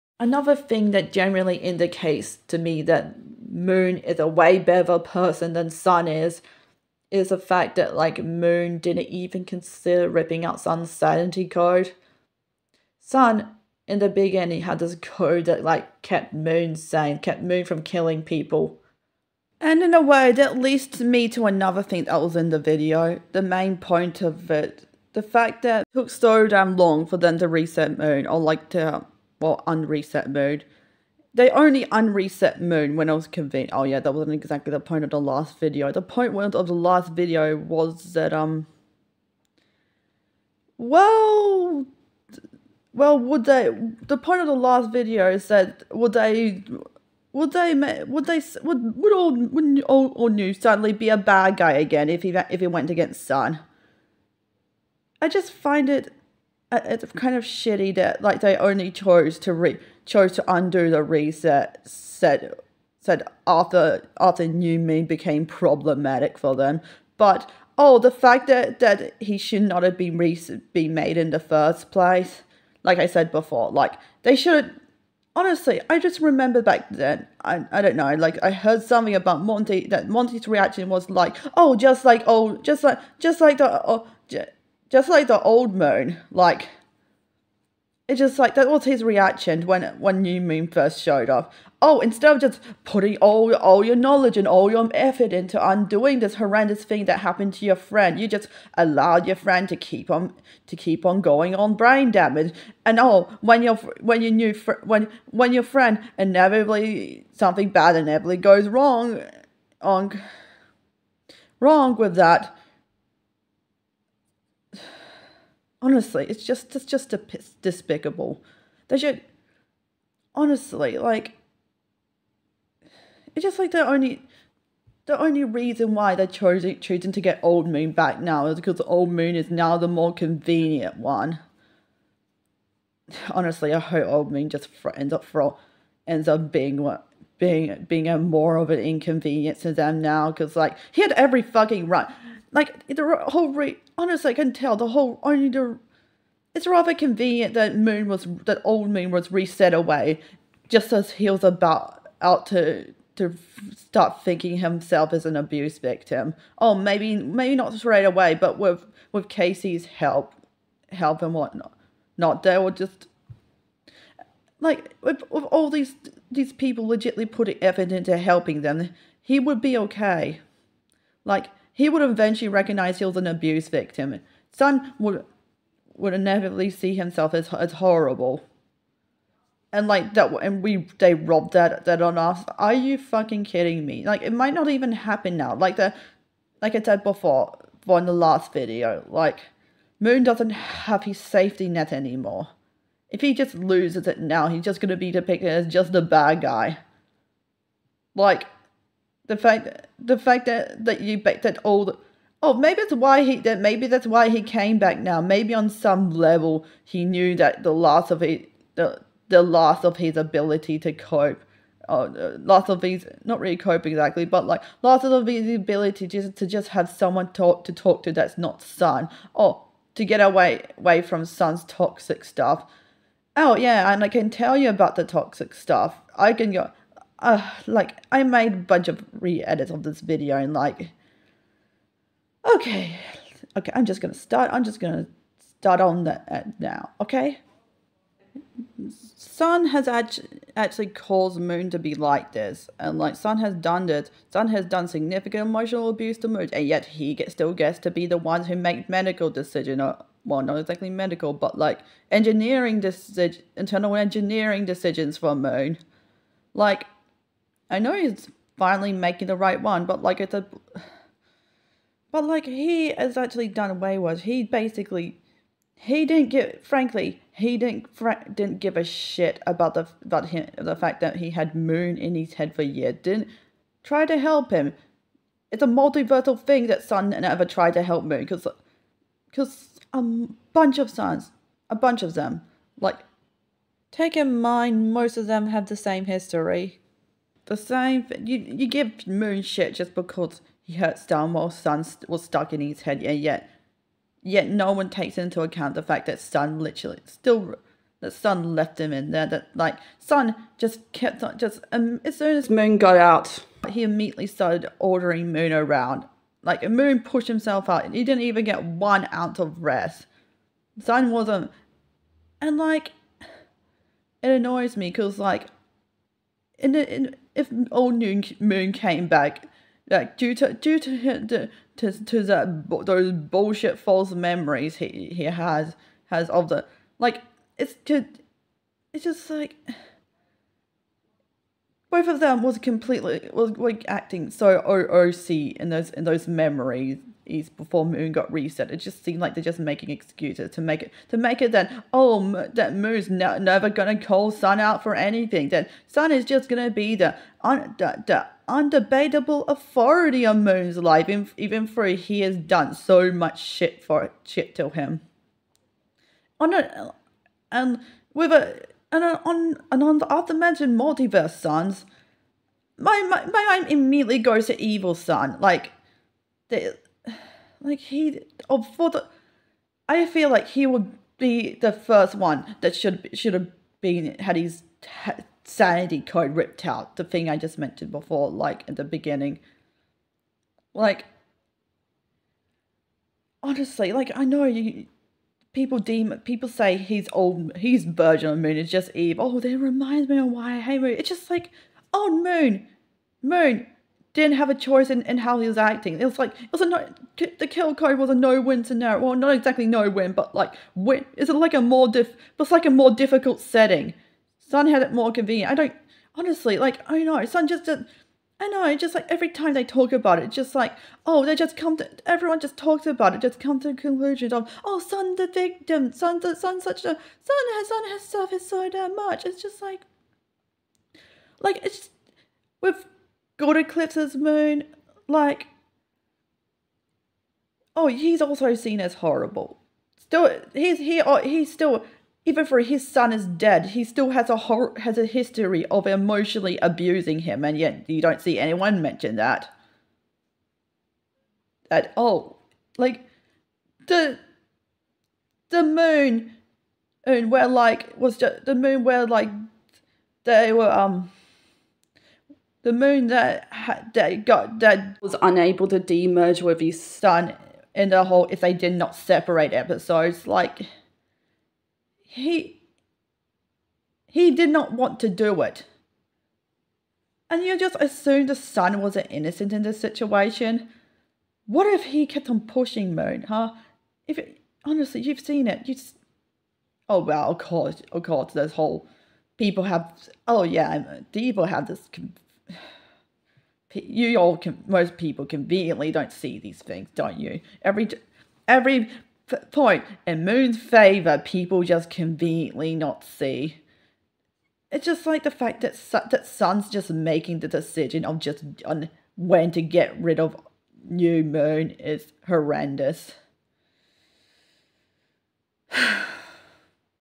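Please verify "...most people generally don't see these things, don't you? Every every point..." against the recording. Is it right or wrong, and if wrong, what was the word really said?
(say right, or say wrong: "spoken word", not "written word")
wrong: "conveniently", not "generally".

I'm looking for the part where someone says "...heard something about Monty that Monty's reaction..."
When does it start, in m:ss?
1:18.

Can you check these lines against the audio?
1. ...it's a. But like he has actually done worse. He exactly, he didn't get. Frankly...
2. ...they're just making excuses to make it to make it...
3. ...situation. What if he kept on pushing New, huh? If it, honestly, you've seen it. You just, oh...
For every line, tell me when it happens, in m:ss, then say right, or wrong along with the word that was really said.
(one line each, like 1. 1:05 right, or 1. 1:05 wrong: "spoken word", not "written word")
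1. 4:20 wrong: "basically", not "exactly"
2. 5:39 right
3. 7:49 wrong: "Moon", not "New".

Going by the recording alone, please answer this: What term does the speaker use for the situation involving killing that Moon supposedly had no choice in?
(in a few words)
Kill card.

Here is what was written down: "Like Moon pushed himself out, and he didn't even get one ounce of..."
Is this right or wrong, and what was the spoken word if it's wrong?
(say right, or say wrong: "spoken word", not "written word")
right.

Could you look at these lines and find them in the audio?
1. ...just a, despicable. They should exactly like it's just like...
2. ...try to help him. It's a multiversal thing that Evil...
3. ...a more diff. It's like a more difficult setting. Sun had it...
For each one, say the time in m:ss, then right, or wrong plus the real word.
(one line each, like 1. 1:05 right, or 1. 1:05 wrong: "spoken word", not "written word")
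1. 1:56 wrong: "honestly", not "exactly"
2. 4:33 wrong: "Sun", not "Evil"
3. 6:41 right.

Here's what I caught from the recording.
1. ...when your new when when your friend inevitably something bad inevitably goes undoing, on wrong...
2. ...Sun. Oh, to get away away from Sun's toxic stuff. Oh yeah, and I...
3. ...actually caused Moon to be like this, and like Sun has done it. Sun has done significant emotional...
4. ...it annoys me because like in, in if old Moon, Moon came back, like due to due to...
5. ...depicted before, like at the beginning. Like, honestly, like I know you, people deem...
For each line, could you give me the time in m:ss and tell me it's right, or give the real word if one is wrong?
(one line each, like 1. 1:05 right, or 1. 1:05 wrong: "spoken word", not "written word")
1. 1:44 wrong: "wrong", not "undoing"
2. 3:38 right
3. 4:00 right
4. 5:13 right
5. 6:17 wrong: "mentioned", not "depicted".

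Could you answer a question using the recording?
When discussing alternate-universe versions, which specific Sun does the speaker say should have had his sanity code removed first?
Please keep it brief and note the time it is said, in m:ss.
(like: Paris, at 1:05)
Evil Sun, at 6:04.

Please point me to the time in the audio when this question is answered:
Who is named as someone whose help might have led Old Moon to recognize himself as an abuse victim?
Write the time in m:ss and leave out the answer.
2:39.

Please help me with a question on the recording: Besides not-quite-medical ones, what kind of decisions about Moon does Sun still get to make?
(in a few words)
Internal engineering decisions.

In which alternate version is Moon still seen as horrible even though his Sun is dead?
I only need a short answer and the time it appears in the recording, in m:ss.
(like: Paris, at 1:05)
Good eclipses, at 7:03.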